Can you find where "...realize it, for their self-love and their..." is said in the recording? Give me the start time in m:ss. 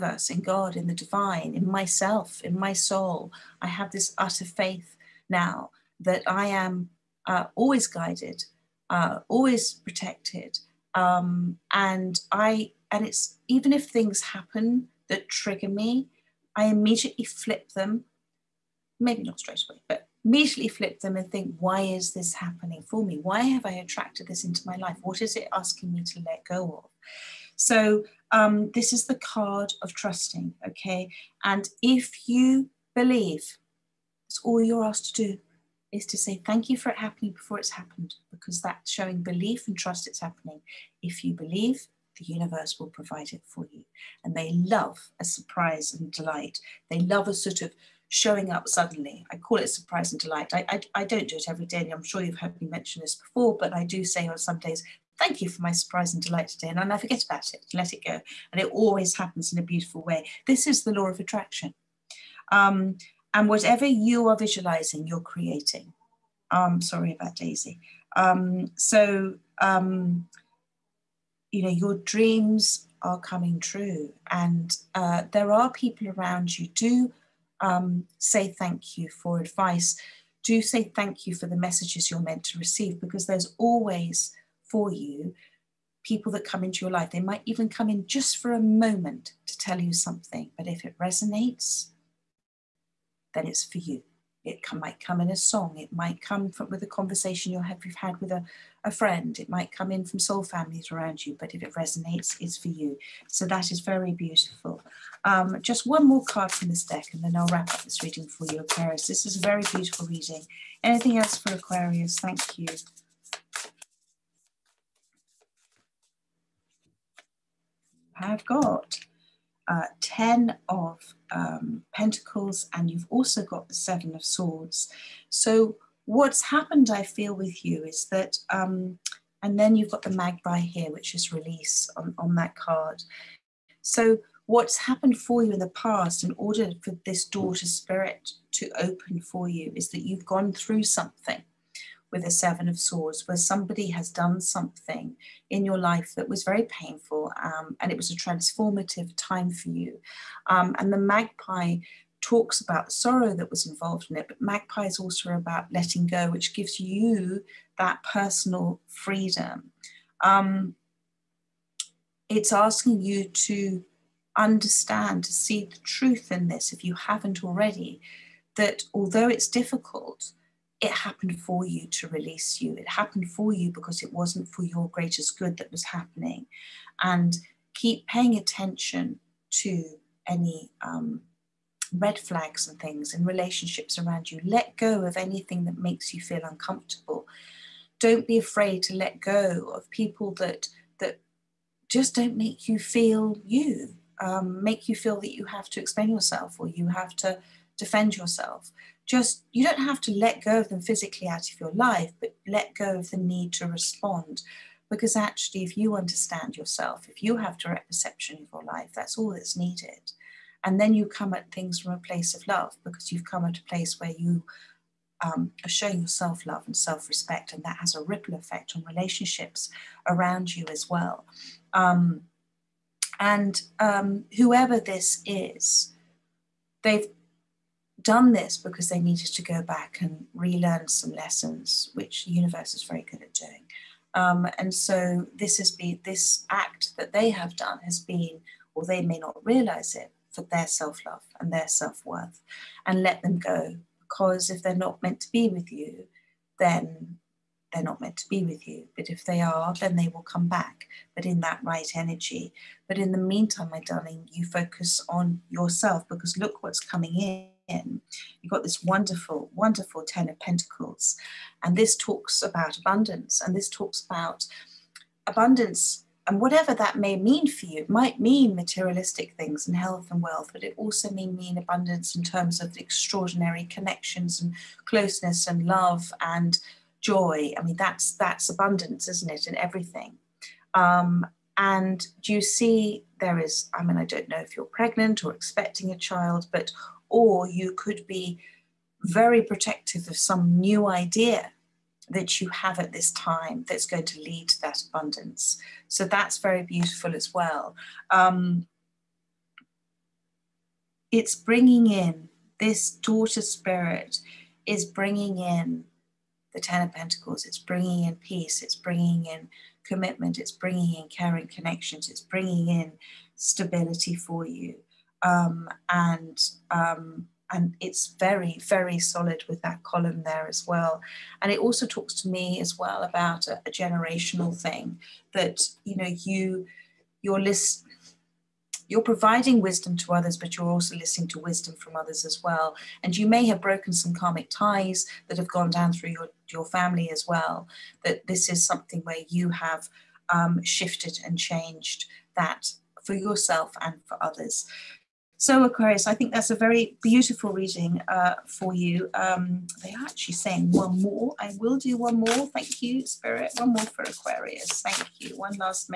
3:59.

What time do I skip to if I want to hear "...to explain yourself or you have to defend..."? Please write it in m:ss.
3:15.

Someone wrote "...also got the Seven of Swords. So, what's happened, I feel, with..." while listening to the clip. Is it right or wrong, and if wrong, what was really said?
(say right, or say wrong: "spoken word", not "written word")
right.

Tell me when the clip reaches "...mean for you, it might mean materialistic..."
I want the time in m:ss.
4:27.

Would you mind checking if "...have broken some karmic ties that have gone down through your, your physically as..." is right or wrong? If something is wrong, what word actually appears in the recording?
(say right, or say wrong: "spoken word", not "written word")
wrong: "family", not "physically".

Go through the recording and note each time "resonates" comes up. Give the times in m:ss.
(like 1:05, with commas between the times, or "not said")
1:30, 1:41.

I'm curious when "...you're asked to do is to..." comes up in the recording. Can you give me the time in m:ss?
0:34.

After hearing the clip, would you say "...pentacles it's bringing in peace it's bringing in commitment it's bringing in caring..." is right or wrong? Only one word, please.
right.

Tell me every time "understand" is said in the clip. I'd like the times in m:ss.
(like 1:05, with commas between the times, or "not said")
2:44, 3:25.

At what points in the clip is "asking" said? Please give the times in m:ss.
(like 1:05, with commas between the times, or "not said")
0:25, 2:42.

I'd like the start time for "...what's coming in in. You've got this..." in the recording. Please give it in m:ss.
4:16.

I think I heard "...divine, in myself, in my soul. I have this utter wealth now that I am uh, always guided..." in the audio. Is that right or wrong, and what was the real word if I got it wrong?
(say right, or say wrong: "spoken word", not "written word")
wrong: "faith", not "wealth".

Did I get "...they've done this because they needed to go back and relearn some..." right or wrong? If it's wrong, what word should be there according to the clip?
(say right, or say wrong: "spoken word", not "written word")
right.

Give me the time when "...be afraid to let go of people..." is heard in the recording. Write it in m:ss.
3:08.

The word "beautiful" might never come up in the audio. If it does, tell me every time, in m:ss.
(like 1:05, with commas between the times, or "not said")
0:59, 1:44, 1:49, 4:56, 5:47.